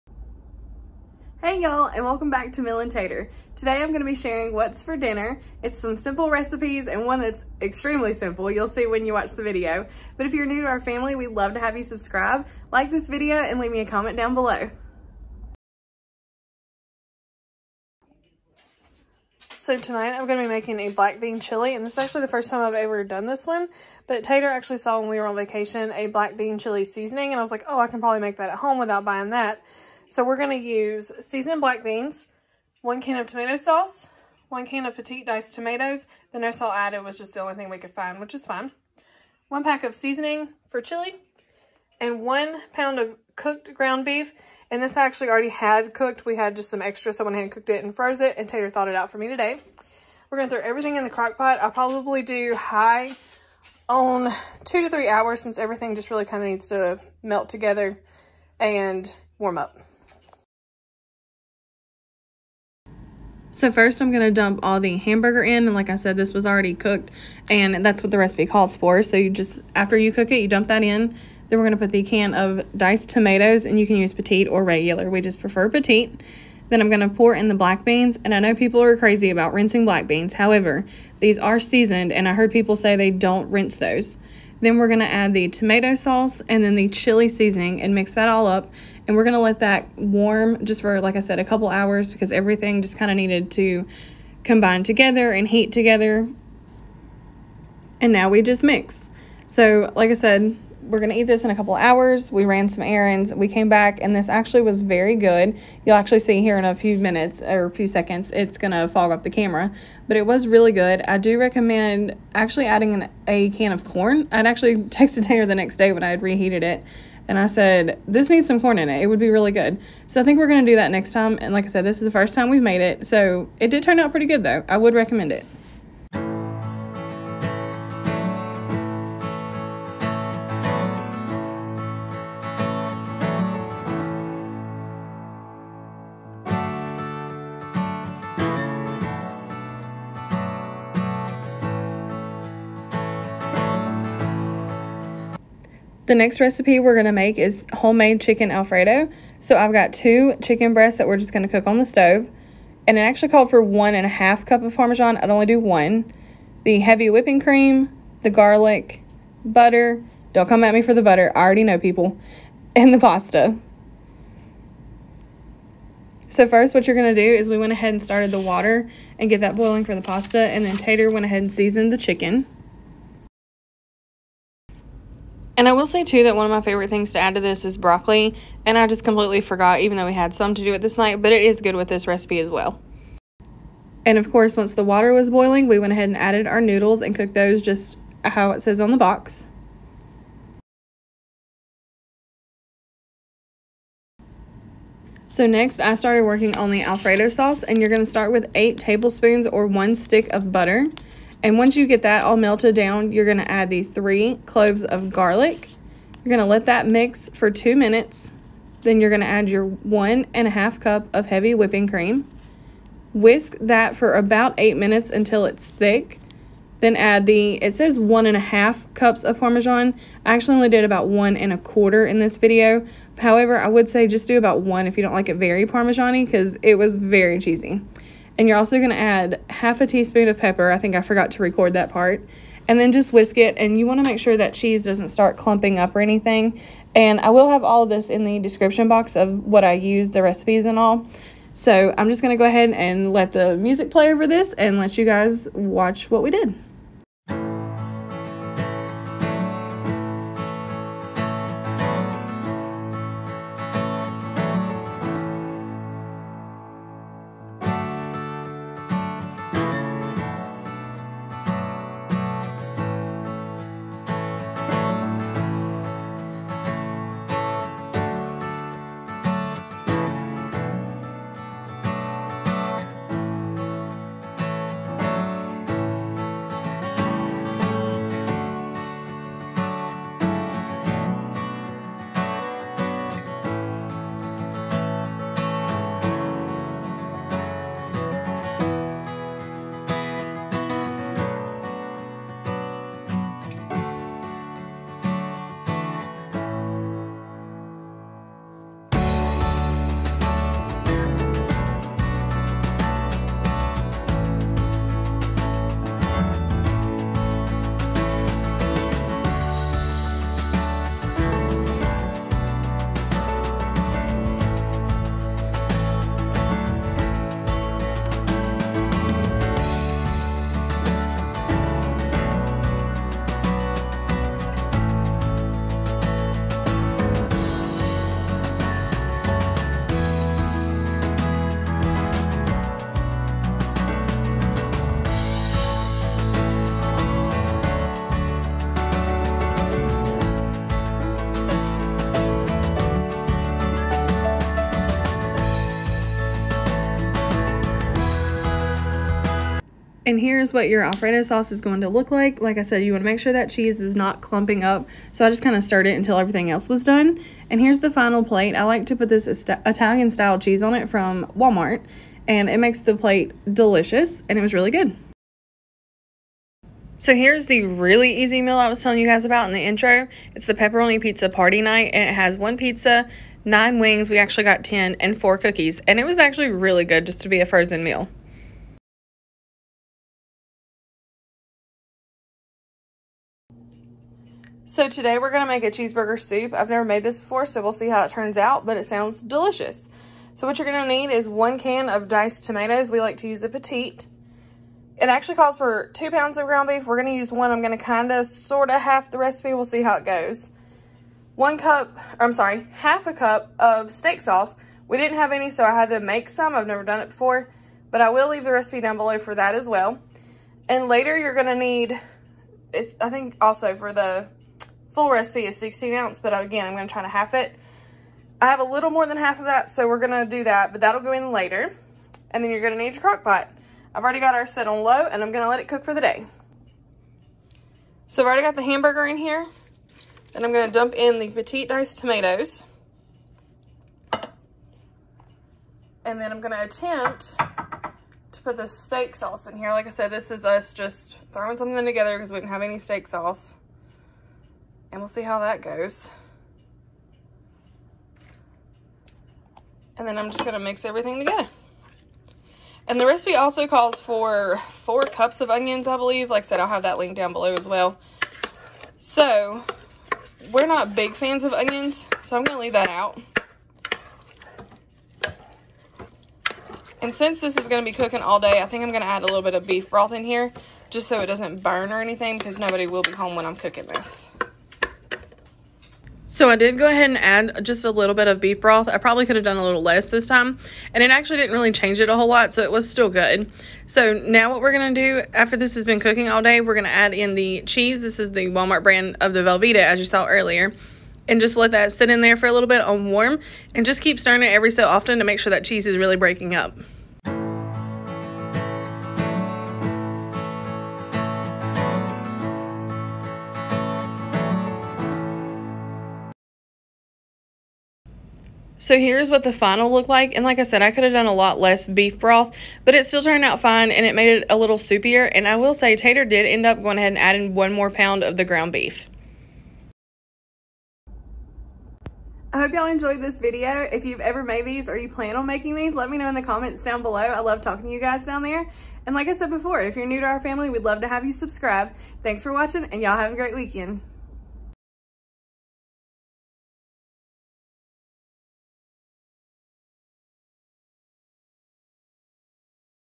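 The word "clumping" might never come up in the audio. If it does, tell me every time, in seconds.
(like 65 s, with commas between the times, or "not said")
235 s, 354 s.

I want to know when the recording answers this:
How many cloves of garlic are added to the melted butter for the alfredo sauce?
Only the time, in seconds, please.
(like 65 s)
203 s.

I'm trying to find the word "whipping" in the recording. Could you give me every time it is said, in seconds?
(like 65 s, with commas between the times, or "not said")
157 s, 211 s.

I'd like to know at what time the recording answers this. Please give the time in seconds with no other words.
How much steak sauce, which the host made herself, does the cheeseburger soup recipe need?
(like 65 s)
402 s.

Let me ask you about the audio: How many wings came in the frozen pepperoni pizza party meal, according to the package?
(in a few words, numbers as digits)
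9.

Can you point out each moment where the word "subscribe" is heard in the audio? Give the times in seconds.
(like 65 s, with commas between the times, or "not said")
11 s, 531 s.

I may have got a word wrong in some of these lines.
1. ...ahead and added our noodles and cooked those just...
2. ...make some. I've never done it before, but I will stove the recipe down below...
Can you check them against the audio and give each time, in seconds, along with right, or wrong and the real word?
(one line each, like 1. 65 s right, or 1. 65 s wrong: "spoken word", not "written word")
1. 185 s right
2. 405 s wrong: "leave", not "stove".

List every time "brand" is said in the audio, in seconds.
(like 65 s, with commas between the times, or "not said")
488 s.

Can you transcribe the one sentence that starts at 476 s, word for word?
So I did go ahead and add just a little bit of beef broth.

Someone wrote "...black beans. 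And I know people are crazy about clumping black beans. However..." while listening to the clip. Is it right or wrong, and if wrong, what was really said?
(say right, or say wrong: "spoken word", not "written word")
wrong: "rinsing", not "clumping".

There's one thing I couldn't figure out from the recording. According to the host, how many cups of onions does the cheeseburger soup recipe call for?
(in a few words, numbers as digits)
4 cups.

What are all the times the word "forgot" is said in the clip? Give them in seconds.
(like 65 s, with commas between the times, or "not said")
179 s, 231 s.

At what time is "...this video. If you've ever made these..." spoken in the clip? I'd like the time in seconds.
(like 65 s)
523 s.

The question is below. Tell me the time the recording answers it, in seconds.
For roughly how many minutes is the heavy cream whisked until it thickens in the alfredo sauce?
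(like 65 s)
214 s.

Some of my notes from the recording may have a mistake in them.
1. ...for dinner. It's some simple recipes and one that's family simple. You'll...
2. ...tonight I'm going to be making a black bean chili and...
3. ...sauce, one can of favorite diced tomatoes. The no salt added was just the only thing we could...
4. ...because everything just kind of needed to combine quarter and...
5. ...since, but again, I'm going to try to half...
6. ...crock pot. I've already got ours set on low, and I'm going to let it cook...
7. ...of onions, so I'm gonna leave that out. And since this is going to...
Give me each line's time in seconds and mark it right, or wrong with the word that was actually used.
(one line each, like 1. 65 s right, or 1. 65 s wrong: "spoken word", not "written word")
1. 4 s wrong: "extremely", not "family"
2. 19 s right
3. 33 s wrong: "petite", not "favorite"
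4. 92 s wrong: "together", not "quarter"
5. 415 s wrong: "ounce", not "since"
6. 423 s right
7. 461 s right.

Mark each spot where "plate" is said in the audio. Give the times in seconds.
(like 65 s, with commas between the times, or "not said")
358 s, 362 s.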